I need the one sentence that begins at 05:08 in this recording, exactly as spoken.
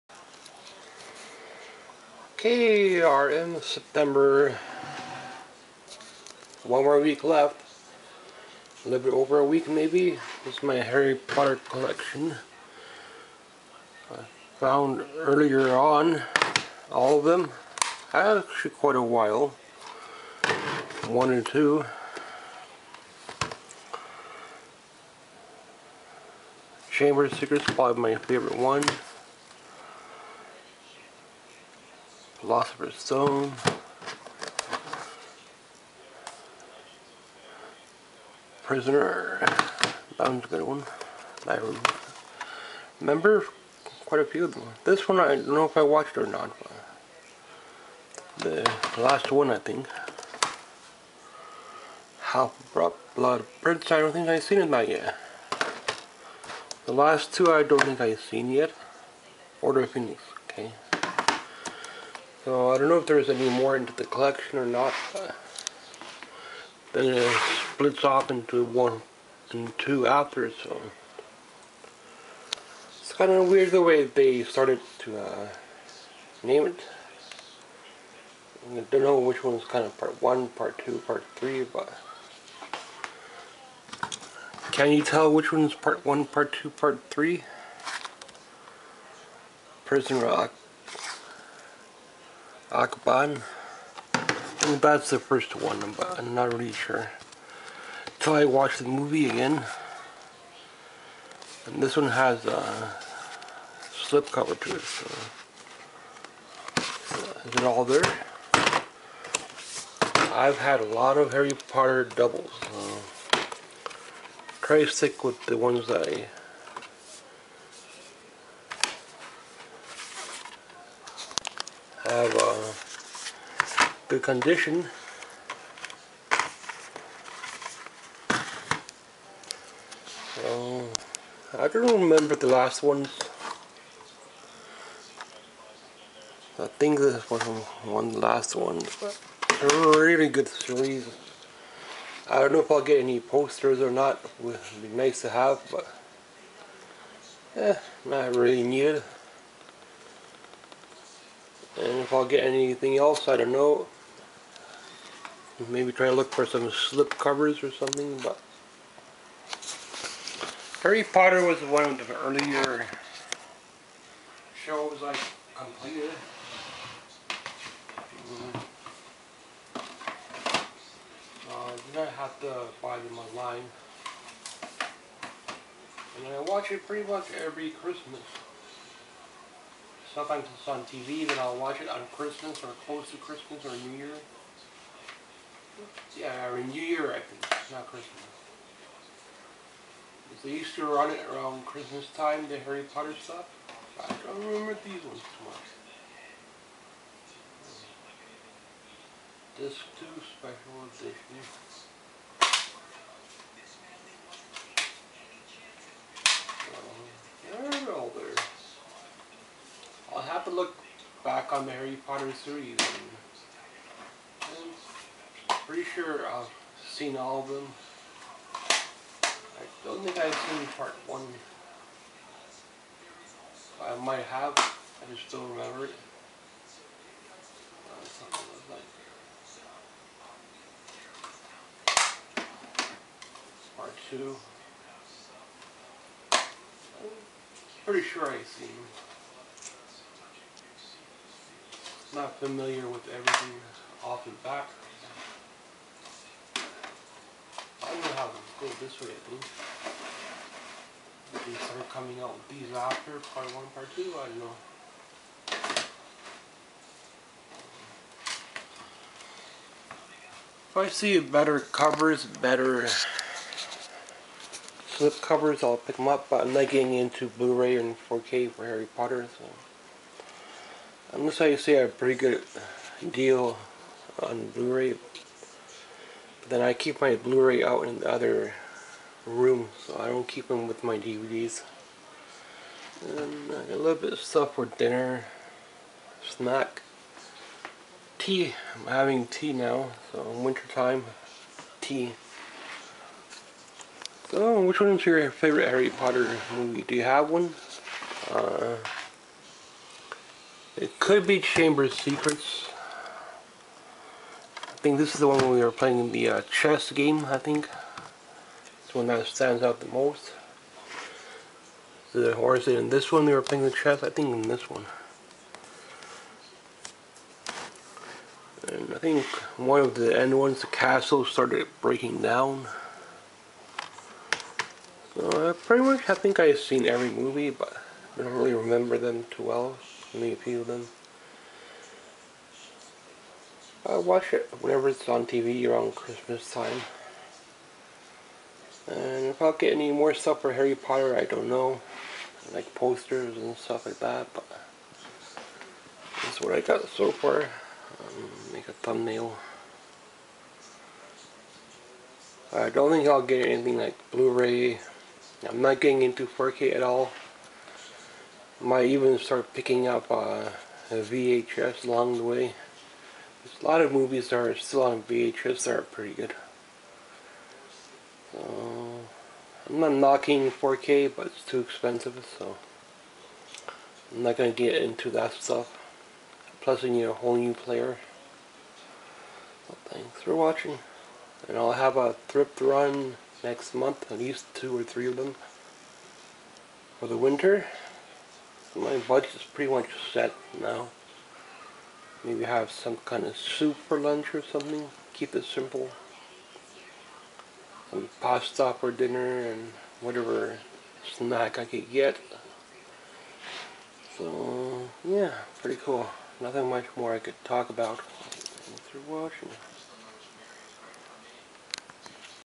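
It's the one that stands out the most.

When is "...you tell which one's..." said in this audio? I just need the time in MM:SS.
01:24.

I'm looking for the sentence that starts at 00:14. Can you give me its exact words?
I found earlier on all of them.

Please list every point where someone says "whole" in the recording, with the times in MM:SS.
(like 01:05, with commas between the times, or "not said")
06:17.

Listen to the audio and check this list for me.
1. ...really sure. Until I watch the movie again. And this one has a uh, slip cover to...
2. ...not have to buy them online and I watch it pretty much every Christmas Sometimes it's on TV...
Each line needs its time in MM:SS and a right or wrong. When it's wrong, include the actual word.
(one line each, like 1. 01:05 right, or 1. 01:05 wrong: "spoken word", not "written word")
1. 01:36 right
2. 02:51 right.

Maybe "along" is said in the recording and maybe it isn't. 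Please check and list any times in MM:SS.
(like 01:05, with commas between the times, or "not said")
06:01.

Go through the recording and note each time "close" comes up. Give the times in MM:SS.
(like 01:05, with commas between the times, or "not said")
03:02.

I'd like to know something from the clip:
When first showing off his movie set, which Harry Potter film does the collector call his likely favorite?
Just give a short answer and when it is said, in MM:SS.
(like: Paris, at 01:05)
Chamber of Secrets, at 00:26.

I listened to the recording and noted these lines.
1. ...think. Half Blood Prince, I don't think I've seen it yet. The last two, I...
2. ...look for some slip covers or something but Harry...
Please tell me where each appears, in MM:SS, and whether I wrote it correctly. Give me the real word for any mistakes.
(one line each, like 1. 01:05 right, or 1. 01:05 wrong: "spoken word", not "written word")
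1. 00:49 right
2. 02:36 right.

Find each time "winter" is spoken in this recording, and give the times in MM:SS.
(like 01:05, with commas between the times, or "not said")
04:50, 06:27.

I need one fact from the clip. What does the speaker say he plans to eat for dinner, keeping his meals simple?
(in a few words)
pasta.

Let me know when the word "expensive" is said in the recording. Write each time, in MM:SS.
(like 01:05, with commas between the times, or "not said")
06:11.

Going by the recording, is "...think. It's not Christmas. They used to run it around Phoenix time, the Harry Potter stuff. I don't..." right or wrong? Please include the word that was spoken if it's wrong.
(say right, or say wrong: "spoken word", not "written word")
wrong: "Christmas", not "Phoenix".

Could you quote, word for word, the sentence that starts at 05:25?
So uh, pretty much I think I've seen every movie, but I don't really remember them too well.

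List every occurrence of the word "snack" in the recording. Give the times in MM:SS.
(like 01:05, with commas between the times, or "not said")
04:46, 06:41.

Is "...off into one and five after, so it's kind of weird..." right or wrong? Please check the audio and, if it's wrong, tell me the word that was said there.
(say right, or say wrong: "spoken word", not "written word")
wrong: "two", not "five".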